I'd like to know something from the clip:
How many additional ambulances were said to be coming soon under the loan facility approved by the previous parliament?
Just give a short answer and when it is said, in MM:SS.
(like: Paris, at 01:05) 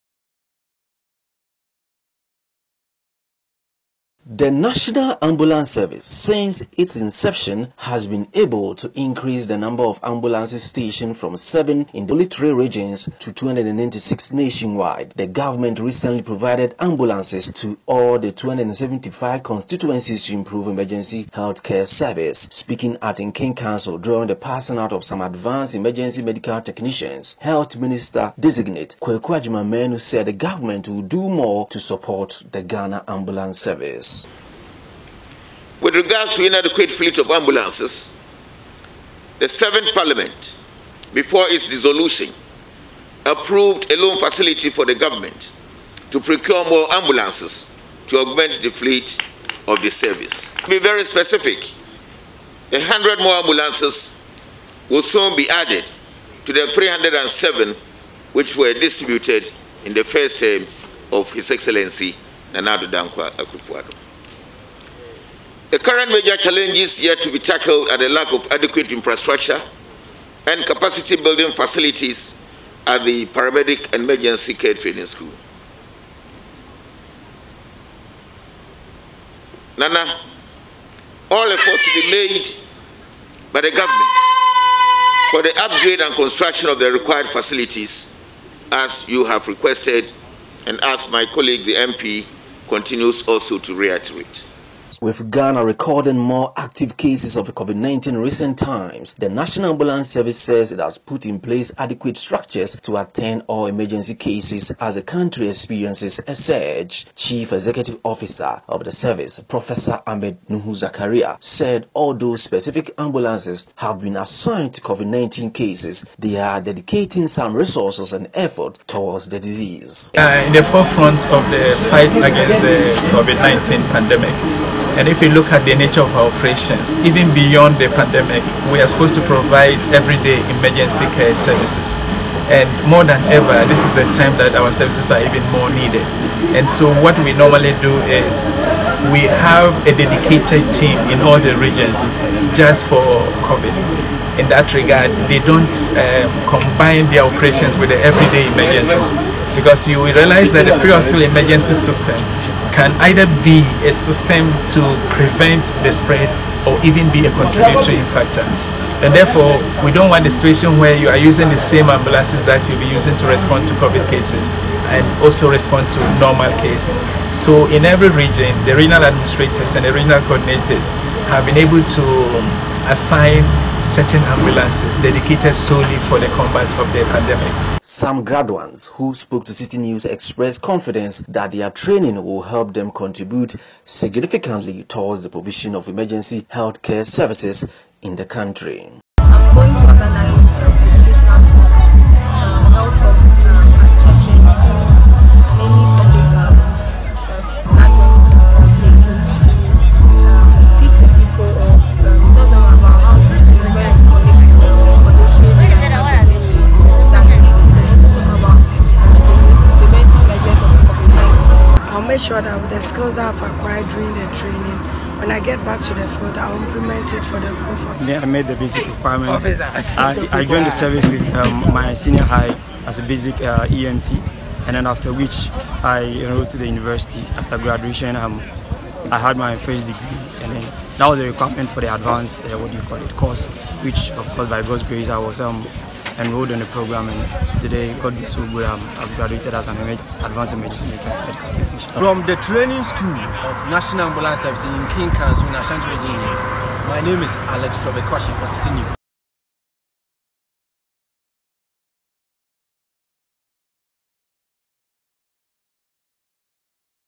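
100, at 00:52.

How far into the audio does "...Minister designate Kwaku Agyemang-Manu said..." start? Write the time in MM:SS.
00:27.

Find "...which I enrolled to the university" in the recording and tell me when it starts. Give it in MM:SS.
03:45.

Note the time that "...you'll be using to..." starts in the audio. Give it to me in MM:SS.
02:42.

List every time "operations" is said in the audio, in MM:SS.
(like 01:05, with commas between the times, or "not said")
02:06, 02:27.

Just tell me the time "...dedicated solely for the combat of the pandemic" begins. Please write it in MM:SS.
02:55.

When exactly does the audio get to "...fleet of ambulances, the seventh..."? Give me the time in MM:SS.
00:36.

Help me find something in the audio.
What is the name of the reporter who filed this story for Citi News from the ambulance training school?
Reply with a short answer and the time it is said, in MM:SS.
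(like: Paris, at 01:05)
Alex Trevor, at 04:07.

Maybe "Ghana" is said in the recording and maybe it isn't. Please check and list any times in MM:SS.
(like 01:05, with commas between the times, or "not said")
00:32, 01:35.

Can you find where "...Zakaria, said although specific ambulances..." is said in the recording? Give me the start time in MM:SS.
01:50.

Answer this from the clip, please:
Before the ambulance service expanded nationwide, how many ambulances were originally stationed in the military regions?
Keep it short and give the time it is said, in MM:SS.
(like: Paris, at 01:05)
7, at 00:11.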